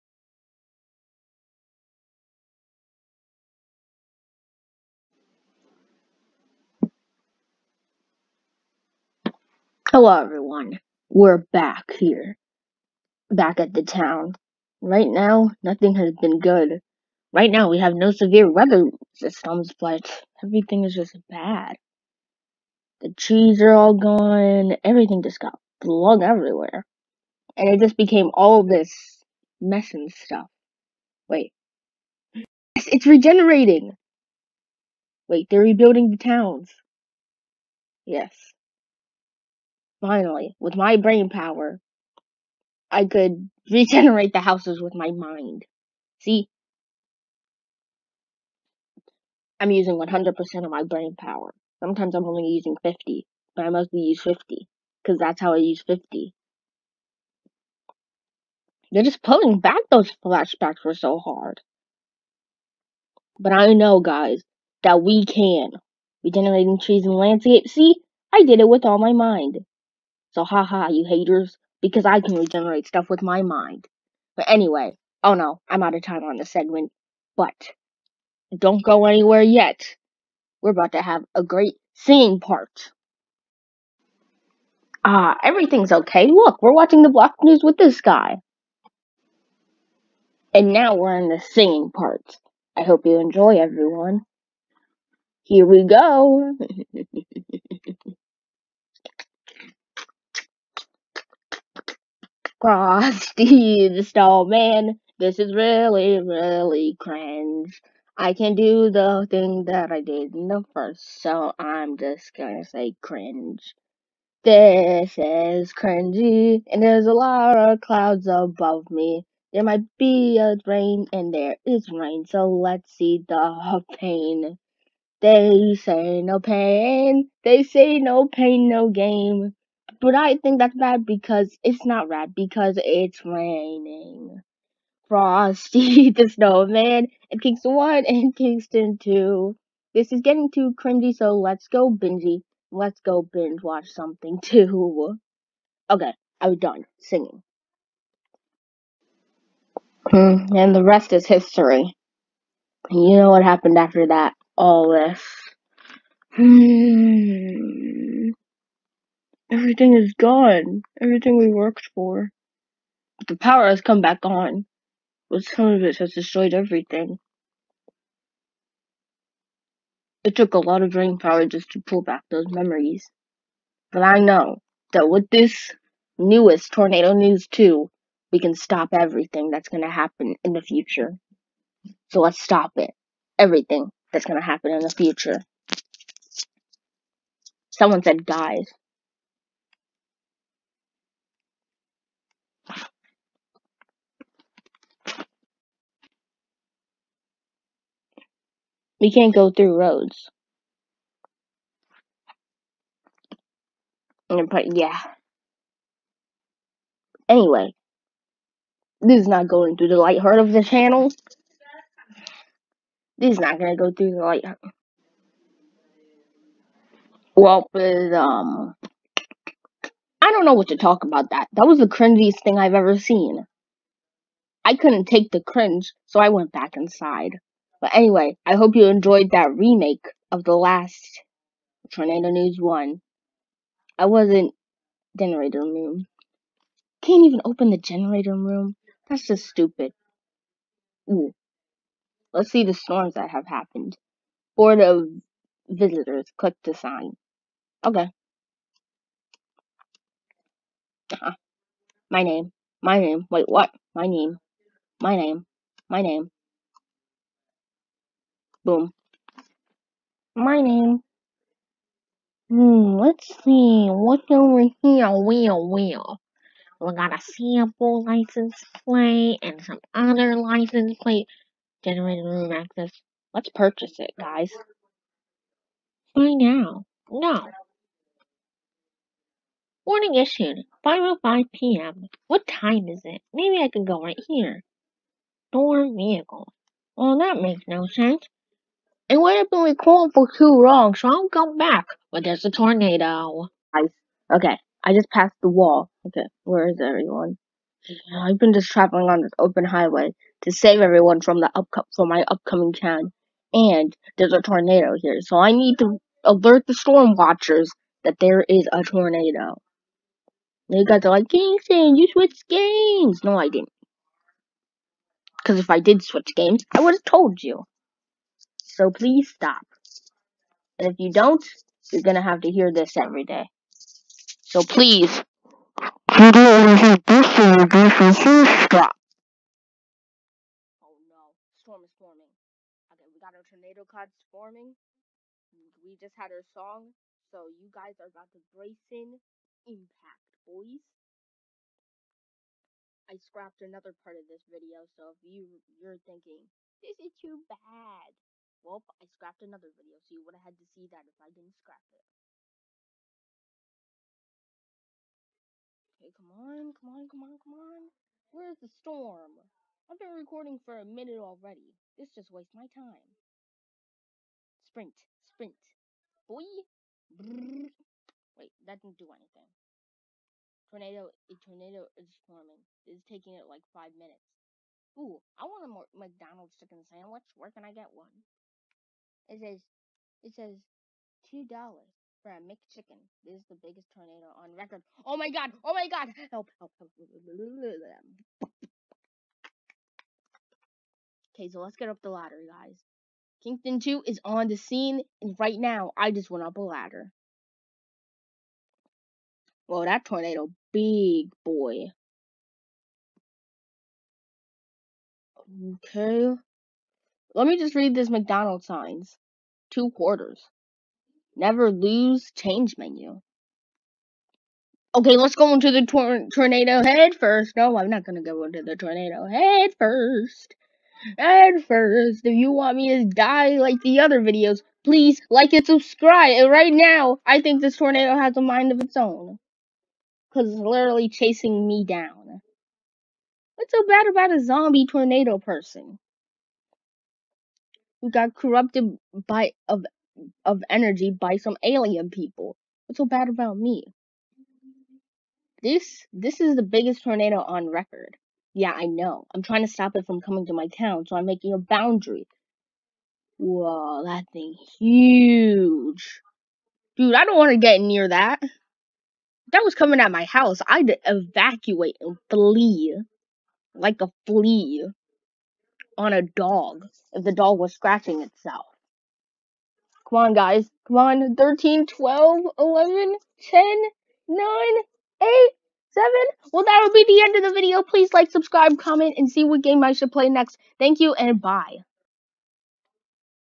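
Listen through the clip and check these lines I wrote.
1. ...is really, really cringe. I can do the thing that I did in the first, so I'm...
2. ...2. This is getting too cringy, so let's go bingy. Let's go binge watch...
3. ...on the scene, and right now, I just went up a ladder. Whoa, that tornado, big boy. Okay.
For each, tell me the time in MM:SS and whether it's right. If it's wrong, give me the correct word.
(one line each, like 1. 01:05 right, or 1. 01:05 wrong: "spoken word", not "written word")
1. 01:45 right
2. 02:18 right
3. 06:34 right.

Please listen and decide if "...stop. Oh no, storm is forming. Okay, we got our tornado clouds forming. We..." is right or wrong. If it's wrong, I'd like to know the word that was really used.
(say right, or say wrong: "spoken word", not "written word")
right.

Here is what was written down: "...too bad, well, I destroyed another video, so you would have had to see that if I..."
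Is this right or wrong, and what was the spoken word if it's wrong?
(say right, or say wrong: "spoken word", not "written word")
wrong: "scrapped", not "destroyed".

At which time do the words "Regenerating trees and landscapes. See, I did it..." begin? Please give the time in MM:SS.
01:06.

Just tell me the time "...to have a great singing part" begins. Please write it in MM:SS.
01:20.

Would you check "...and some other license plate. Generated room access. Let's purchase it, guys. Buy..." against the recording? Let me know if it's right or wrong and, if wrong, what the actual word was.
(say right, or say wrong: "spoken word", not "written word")
right.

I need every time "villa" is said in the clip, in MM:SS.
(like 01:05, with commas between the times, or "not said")
not said.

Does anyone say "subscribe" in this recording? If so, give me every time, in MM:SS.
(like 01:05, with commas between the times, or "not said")
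07:05, 07:58.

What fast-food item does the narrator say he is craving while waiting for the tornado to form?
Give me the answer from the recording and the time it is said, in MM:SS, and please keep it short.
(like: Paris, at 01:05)
McDonald's chicken sandwich, at 06:15.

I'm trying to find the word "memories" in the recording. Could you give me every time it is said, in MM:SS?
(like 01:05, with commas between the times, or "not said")
02:52.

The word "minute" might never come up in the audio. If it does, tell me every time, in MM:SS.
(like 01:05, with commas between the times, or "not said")
06:00, 06:13.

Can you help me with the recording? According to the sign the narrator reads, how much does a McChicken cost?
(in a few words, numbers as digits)
$2.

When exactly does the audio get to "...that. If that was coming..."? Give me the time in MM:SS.
07:38.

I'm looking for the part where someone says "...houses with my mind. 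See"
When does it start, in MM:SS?
00:44.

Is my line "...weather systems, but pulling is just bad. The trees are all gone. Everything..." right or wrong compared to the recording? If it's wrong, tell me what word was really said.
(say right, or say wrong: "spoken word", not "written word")
wrong: "everything", not "pulling".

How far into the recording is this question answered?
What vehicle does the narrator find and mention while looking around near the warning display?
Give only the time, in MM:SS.
04:45.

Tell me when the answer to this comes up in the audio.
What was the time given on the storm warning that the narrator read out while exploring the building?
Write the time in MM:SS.
04:40.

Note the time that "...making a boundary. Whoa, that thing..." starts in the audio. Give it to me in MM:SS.
07:31.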